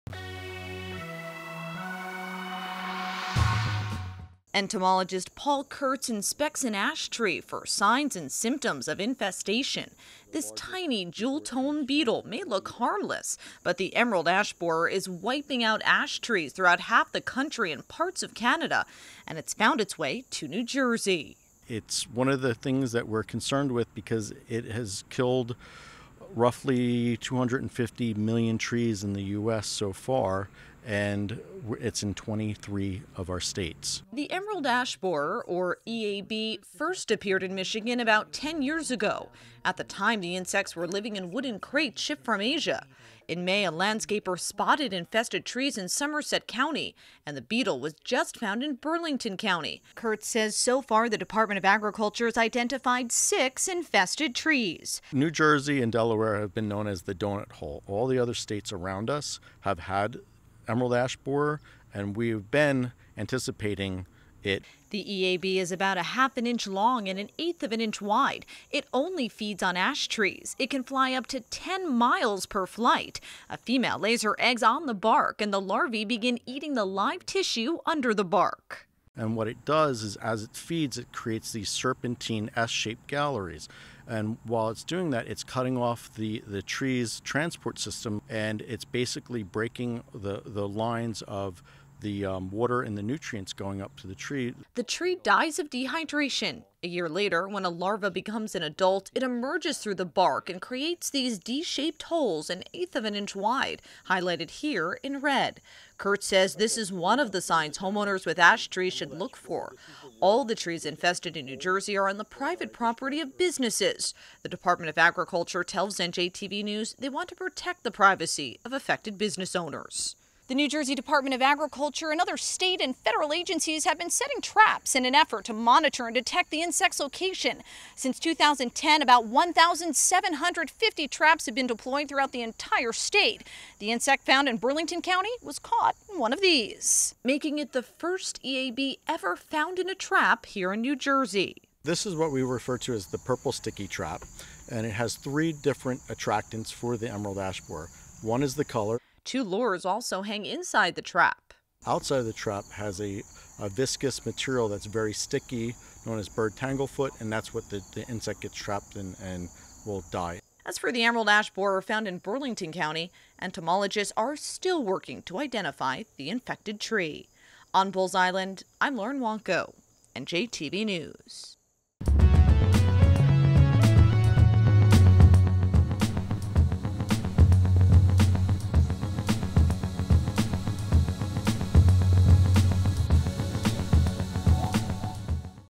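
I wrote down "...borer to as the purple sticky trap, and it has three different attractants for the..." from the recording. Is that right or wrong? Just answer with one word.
wrong.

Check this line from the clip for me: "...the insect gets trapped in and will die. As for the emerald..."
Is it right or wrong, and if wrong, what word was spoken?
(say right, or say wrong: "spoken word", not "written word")
right.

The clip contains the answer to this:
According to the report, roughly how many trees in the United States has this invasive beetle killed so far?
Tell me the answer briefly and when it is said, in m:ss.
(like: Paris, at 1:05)
250 million, at 0:27.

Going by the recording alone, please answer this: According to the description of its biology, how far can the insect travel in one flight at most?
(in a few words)
10 miles.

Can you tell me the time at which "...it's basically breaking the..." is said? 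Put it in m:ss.
1:28.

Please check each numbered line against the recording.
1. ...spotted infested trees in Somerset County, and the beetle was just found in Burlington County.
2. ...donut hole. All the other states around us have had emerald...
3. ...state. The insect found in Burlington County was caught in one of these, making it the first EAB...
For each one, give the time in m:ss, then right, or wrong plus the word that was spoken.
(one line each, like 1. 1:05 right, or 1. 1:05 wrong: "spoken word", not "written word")
1. 0:44 right
2. 0:57 right
3. 2:12 right.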